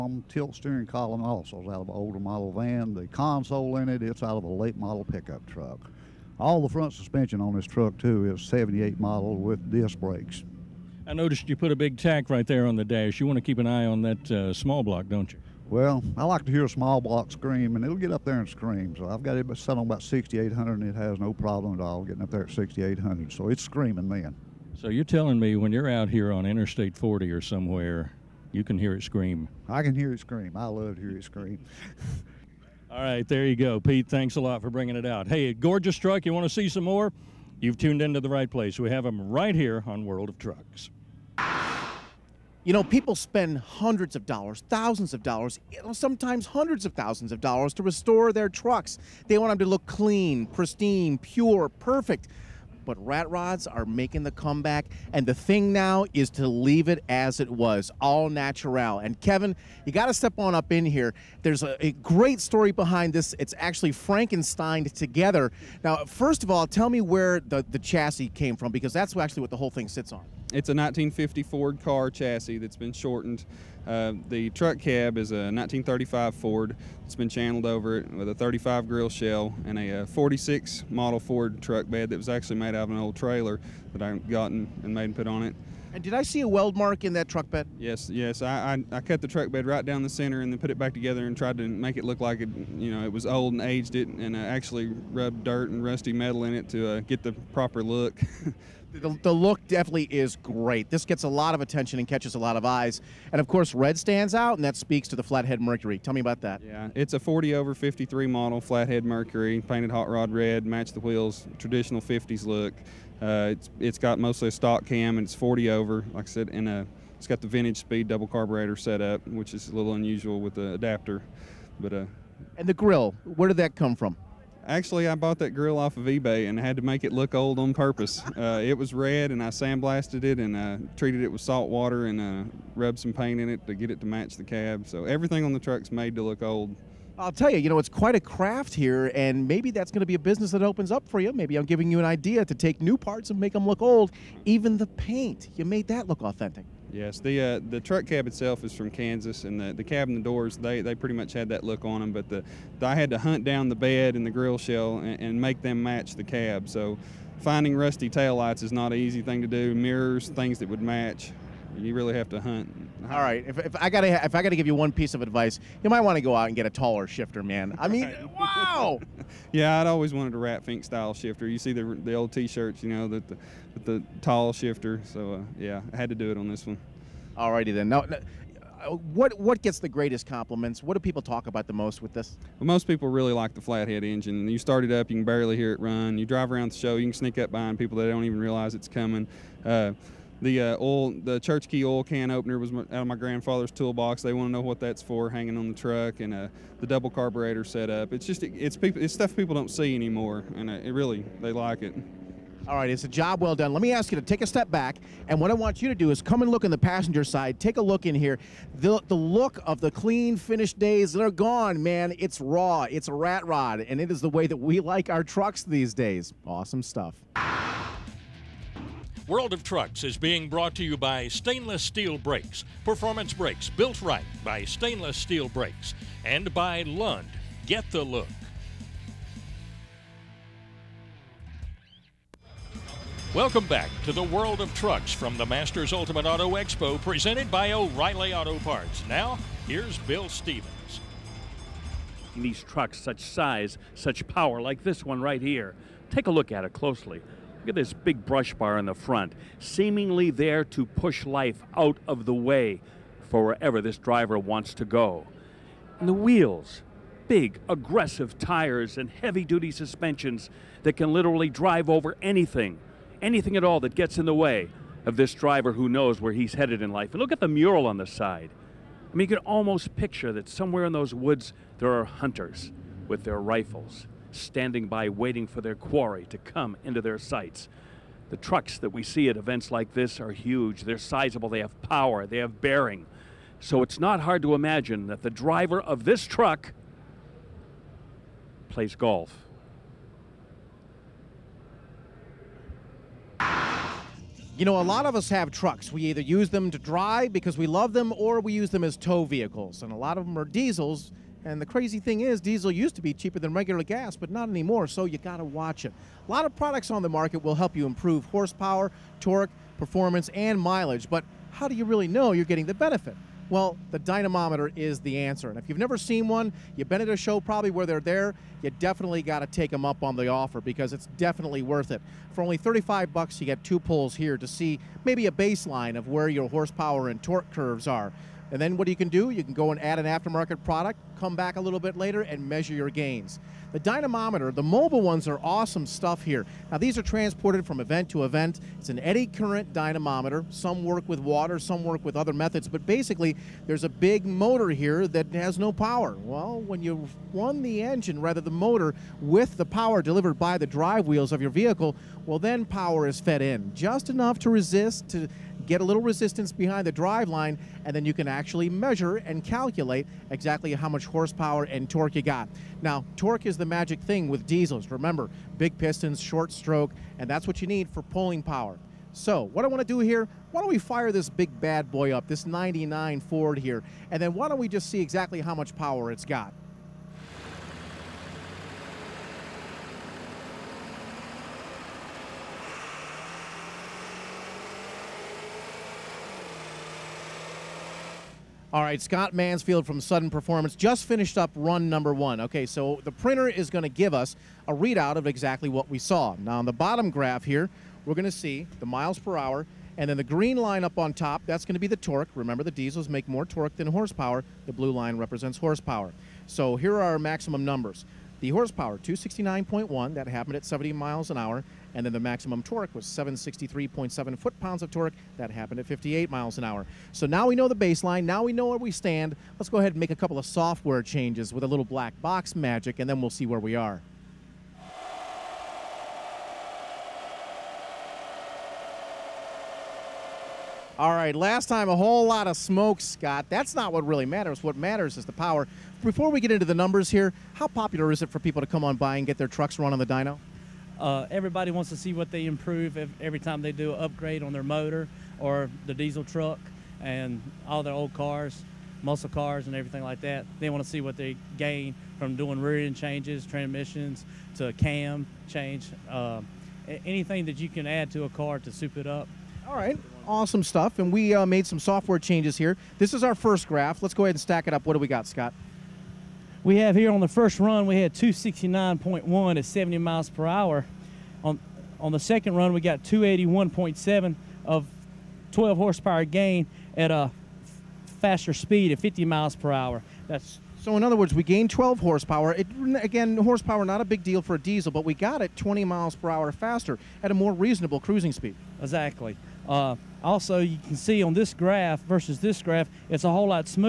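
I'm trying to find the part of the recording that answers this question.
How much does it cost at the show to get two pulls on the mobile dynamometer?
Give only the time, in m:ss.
5:22.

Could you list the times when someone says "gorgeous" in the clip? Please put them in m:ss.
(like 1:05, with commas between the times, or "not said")
0:35.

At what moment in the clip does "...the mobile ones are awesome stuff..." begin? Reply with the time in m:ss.
5:34.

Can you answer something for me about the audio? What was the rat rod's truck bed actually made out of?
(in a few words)
an old trailer.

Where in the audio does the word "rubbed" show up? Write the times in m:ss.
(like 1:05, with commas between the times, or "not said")
1:35, 2:12.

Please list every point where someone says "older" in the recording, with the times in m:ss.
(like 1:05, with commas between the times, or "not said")
0:01.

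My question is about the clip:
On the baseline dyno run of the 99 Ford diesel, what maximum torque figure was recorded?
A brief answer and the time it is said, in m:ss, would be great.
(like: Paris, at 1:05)
763.7 foot pounds, at 6:53.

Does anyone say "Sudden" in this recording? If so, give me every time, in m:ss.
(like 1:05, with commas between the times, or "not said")
6:30.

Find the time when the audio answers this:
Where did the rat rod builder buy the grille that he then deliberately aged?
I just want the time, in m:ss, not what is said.
2:06.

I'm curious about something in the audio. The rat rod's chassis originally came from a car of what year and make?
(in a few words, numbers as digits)
1950 Ford.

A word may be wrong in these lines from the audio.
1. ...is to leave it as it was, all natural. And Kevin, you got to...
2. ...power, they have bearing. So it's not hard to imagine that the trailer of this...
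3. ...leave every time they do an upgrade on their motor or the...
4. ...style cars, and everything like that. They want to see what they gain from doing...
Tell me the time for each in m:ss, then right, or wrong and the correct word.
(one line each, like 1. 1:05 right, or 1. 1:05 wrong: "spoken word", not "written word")
1. 0:56 right
2. 4:41 wrong: "driver", not "trailer"
3. 7:22 wrong: "improve", not "leave"
4. 7:29 wrong: "muscle", not "style".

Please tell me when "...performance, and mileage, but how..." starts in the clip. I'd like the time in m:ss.
5:09.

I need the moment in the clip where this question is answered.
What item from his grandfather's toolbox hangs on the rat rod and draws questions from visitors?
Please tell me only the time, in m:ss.
3:11.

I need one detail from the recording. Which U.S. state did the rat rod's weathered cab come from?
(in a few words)
Kansas.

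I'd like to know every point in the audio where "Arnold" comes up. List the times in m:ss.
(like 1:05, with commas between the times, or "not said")
not said.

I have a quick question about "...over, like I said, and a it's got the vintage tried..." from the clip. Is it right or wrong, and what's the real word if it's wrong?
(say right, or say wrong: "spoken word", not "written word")
wrong: "speed", not "tried".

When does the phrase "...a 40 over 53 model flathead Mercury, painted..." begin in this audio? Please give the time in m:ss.
1:47.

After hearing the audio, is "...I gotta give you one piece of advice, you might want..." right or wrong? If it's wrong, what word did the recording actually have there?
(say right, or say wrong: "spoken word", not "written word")
right.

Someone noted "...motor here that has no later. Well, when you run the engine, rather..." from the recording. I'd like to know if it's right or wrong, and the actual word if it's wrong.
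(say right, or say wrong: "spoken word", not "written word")
wrong: "power", not "later".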